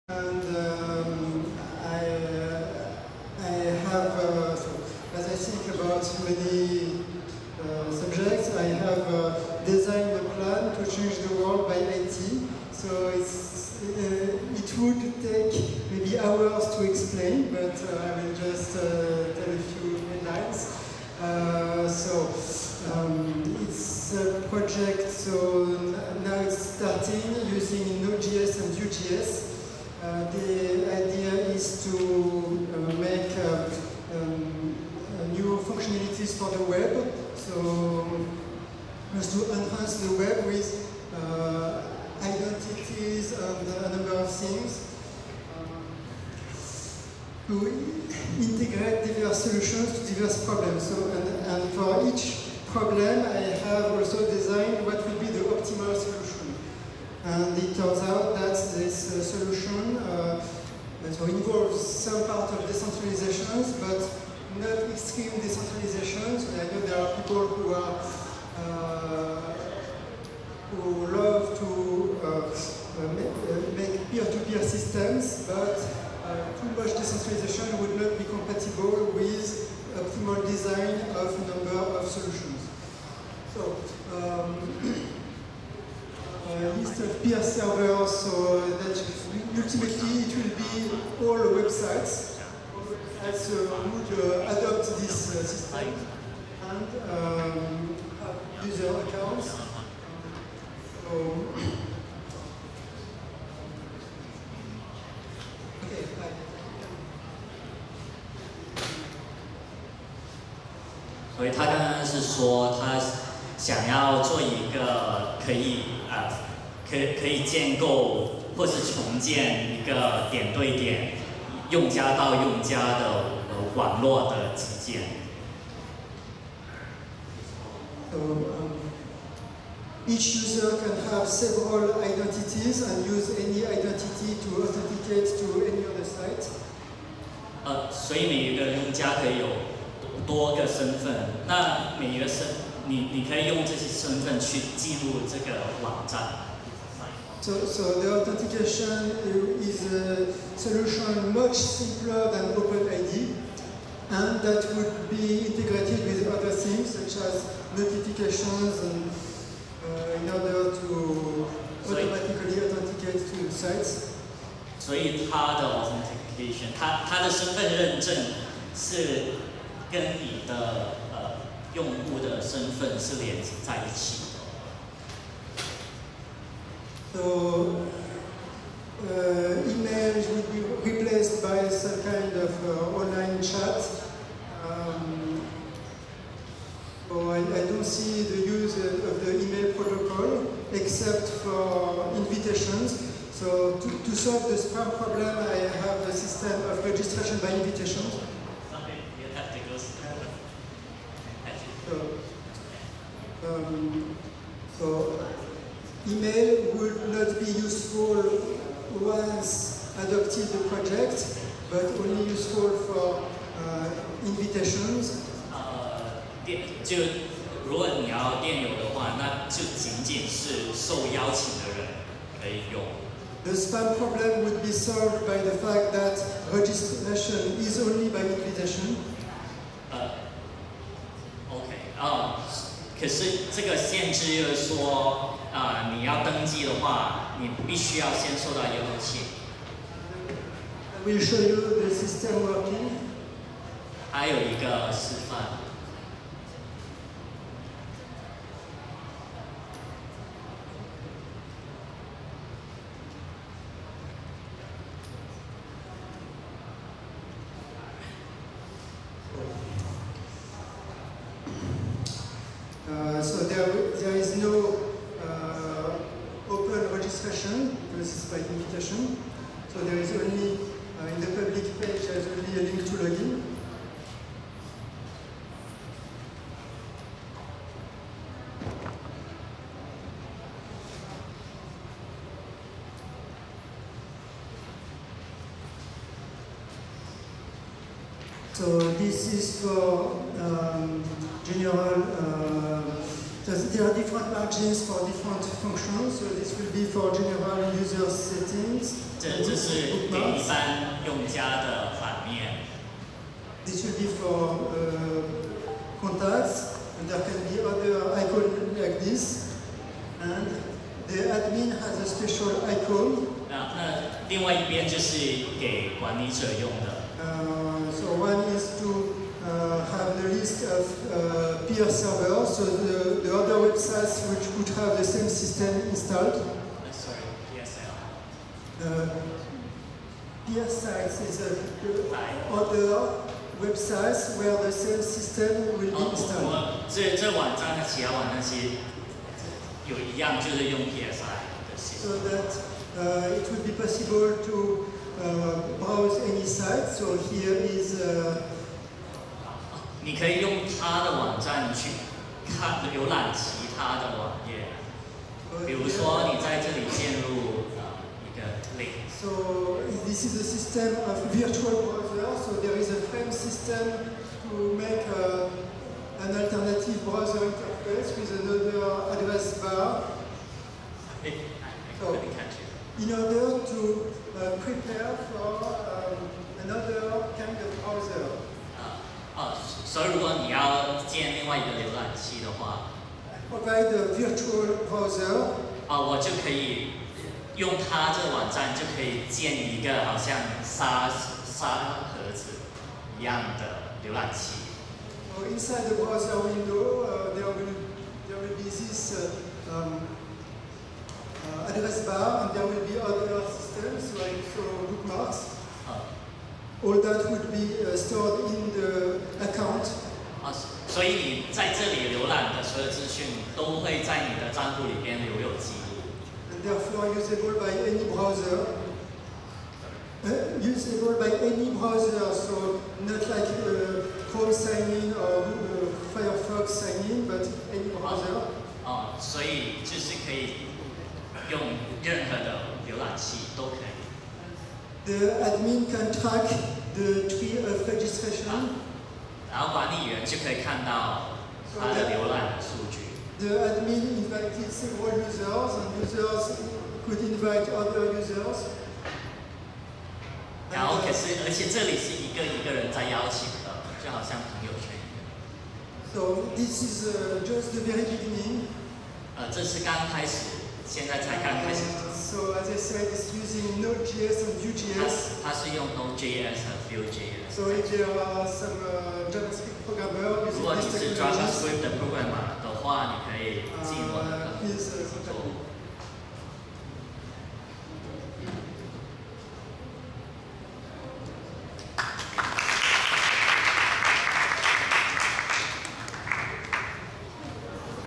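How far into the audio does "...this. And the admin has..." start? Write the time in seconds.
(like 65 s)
309 s.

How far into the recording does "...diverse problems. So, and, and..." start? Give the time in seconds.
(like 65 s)
50 s.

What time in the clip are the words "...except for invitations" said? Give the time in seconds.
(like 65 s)
190 s.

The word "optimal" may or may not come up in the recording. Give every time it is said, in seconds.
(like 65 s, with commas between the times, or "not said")
55 s, 79 s.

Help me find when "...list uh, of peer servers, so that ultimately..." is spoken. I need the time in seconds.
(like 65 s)
86 s.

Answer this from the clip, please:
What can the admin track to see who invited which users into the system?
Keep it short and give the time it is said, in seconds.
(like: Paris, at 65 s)
tree of registration, at 436 s.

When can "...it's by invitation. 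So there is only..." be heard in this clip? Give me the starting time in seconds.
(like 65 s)
268 s.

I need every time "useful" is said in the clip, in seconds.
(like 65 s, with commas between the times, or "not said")
207 s, 212 s.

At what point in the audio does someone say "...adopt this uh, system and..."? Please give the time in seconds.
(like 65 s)
94 s.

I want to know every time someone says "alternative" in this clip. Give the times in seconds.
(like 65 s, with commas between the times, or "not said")
366 s.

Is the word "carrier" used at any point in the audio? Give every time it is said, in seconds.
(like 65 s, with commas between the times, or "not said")
not said.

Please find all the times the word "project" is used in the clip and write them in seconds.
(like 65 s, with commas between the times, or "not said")
24 s, 210 s.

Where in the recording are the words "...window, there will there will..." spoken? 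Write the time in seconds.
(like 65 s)
396 s.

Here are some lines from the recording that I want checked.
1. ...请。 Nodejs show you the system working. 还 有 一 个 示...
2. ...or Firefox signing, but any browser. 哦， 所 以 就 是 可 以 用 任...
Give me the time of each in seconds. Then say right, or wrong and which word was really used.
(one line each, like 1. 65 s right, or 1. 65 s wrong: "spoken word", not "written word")
1. 239 s wrong: "Will", not "Nodejs"
2. 425 s right.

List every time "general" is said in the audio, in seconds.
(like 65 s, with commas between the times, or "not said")
291 s, 297 s.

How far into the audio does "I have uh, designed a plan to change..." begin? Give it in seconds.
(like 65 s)
8 s.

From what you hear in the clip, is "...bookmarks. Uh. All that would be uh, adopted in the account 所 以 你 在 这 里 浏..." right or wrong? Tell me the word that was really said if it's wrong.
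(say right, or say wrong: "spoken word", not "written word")
wrong: "stored", not "adopted".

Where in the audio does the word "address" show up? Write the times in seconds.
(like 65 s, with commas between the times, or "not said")
369 s, 401 s.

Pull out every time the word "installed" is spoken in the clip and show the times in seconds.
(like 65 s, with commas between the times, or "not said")
325 s, 336 s.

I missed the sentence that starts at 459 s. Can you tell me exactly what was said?
呃， 这 是 刚 开 始。 现 在 才 刚 开 始。 So as I said, it's using Node.js and Vue.js.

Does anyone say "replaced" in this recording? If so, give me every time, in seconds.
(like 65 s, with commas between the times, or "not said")
180 s.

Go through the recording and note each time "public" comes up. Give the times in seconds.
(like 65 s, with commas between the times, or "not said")
271 s.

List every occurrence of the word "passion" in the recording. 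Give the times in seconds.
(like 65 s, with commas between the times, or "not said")
not said.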